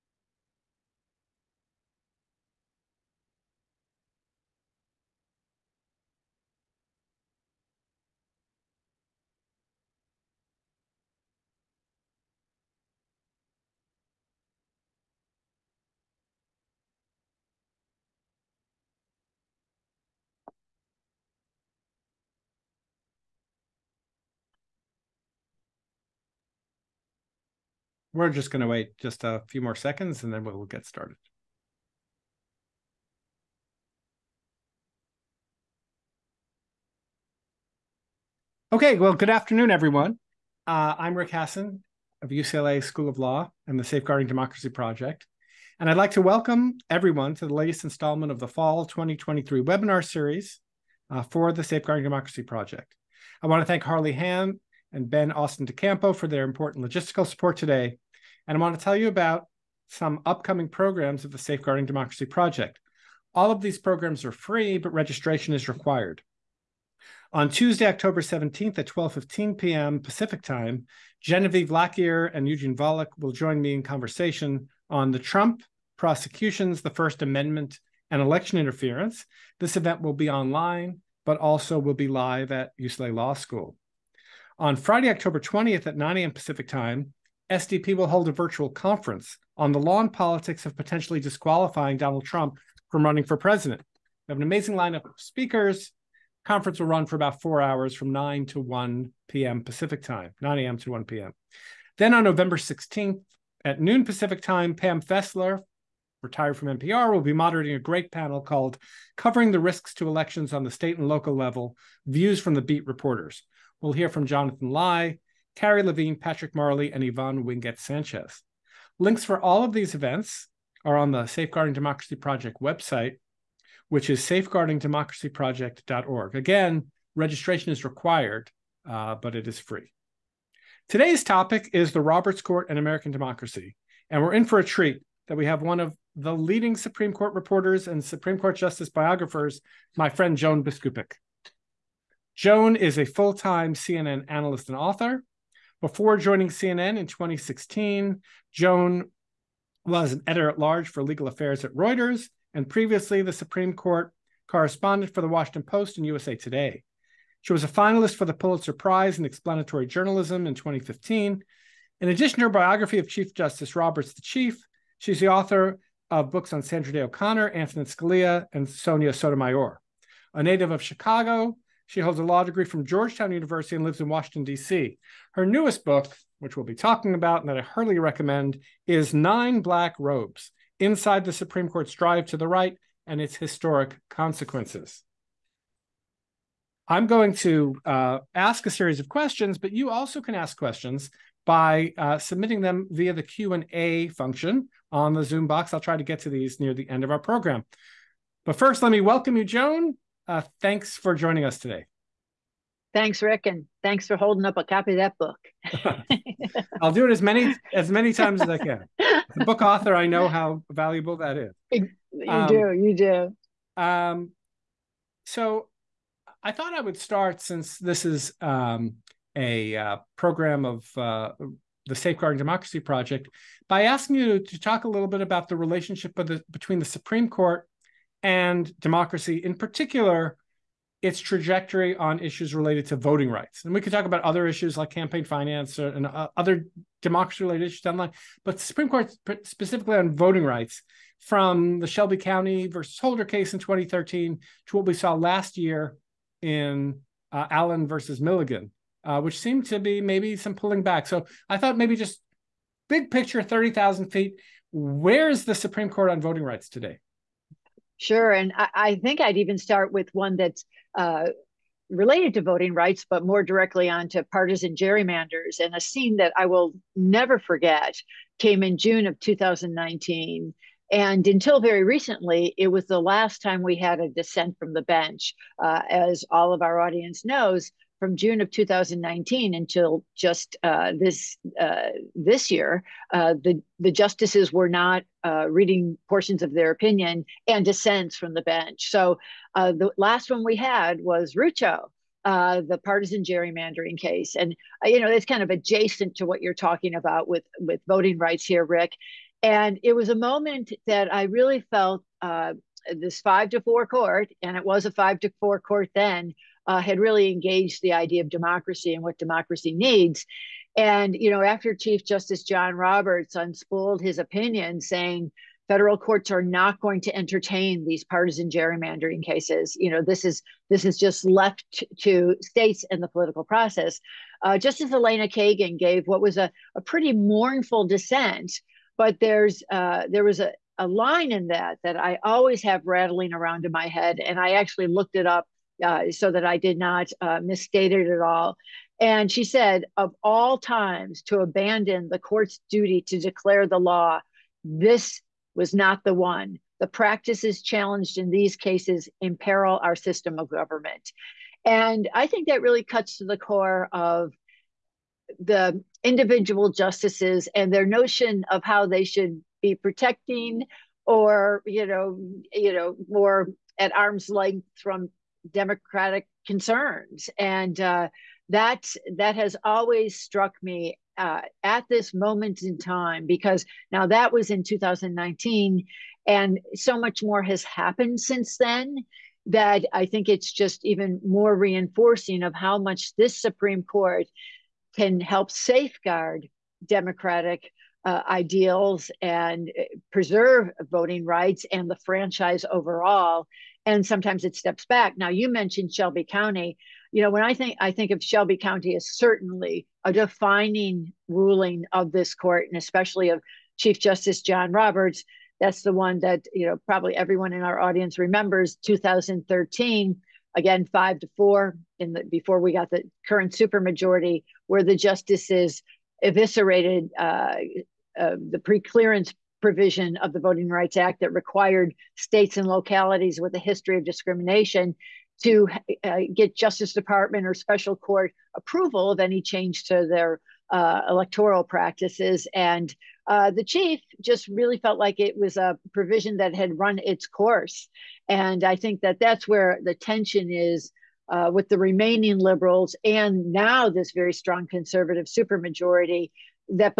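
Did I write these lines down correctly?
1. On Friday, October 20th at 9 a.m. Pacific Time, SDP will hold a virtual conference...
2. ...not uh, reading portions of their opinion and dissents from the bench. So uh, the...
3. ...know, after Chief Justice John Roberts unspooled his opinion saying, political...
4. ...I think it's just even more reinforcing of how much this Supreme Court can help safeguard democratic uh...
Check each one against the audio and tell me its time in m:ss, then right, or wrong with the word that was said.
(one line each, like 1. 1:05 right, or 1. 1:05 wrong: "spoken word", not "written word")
1. 1:24 right
2. 4:44 right
3. 5:11 wrong: "federal", not "political"
4. 6:19 right.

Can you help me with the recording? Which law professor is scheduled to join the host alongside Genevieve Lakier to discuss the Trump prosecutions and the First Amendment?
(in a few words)
Eugene Volokh.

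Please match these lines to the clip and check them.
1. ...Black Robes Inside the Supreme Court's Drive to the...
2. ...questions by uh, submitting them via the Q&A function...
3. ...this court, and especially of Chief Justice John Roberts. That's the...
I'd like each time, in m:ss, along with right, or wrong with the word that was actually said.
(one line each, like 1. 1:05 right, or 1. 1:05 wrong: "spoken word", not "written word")
1. 2:59 right
2. 3:10 right
3. 6:42 right.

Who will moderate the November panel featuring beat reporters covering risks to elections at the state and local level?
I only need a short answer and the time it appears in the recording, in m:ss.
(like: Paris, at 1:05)
Pam Fessler, at 1:44.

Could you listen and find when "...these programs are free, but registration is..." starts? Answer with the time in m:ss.
1:03.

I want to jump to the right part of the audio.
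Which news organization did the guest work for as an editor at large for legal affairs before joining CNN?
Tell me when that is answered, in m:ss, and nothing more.
2:31.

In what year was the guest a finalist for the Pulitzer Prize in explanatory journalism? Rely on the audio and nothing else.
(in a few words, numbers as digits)
2015.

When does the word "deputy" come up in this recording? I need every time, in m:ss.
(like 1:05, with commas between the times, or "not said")
not said.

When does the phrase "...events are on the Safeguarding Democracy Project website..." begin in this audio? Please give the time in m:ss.
1:59.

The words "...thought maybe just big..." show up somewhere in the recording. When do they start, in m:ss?
4:11.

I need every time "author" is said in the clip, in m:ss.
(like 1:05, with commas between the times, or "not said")
2:24, 2:45, 3:29.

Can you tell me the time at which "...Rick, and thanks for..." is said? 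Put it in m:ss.
3:23.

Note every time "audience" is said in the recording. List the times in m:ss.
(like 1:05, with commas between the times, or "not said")
4:36, 6:47.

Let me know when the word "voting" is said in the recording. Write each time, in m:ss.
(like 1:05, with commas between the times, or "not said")
3:52, 4:00, 4:16, 4:22, 4:57, 6:30, 7:00.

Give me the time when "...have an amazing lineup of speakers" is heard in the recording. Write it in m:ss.
1:34.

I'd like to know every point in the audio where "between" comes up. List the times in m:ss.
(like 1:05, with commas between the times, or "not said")
3:46.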